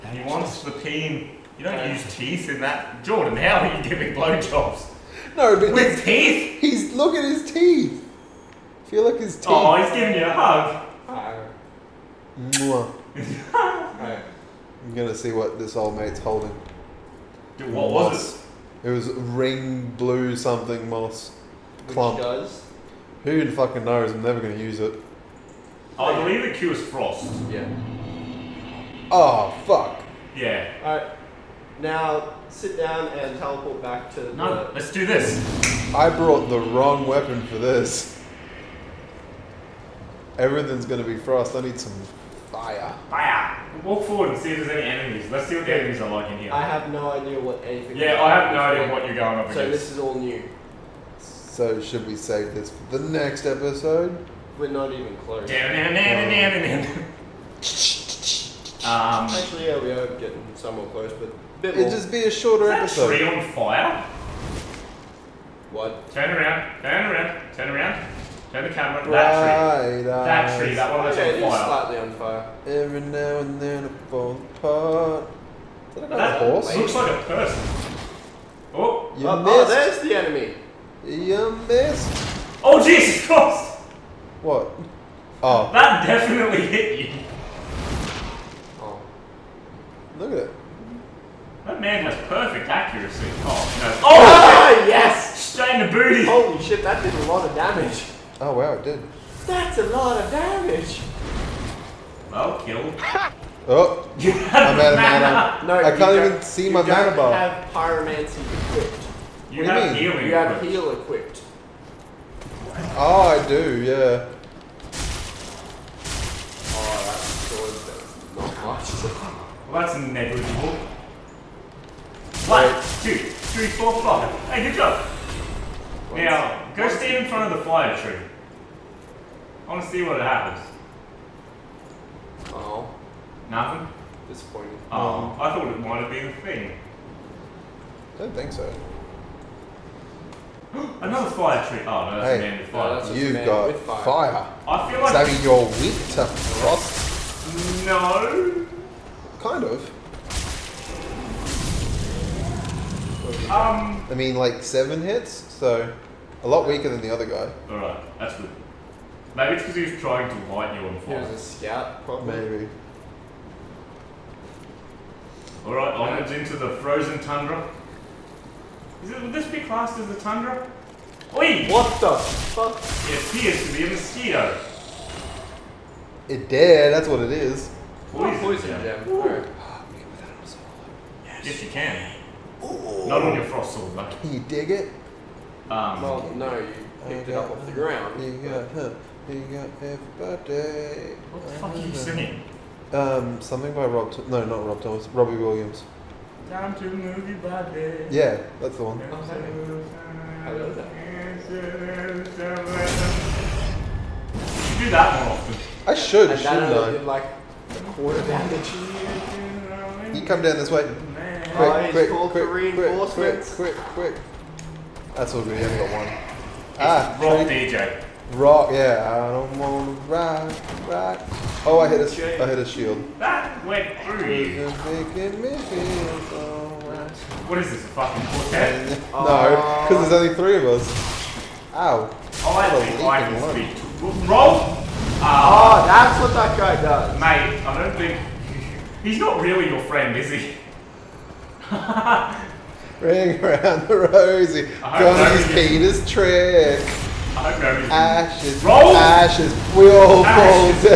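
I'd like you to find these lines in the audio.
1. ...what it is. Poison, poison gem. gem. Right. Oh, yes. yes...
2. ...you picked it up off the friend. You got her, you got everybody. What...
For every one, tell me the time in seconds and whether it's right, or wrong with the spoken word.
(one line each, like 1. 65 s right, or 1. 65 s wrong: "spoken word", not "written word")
1. 177 s right
2. 186 s wrong: "ground", not "friend".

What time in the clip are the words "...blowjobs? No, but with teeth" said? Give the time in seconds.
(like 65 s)
4 s.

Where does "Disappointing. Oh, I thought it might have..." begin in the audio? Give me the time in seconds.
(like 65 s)
134 s.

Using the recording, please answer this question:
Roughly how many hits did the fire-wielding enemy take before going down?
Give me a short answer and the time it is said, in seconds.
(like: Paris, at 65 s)
7, at 154 s.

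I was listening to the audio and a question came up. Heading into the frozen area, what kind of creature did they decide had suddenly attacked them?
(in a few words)
A mosquito.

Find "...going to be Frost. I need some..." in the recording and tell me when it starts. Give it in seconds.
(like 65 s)
40 s.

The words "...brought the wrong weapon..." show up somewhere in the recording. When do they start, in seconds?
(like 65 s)
36 s.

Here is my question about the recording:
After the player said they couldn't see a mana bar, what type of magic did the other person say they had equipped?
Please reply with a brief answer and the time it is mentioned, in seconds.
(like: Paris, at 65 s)
Pyromancy, at 107 s.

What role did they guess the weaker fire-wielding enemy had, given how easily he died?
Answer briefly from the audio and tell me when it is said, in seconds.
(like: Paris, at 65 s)
Scout, at 161 s.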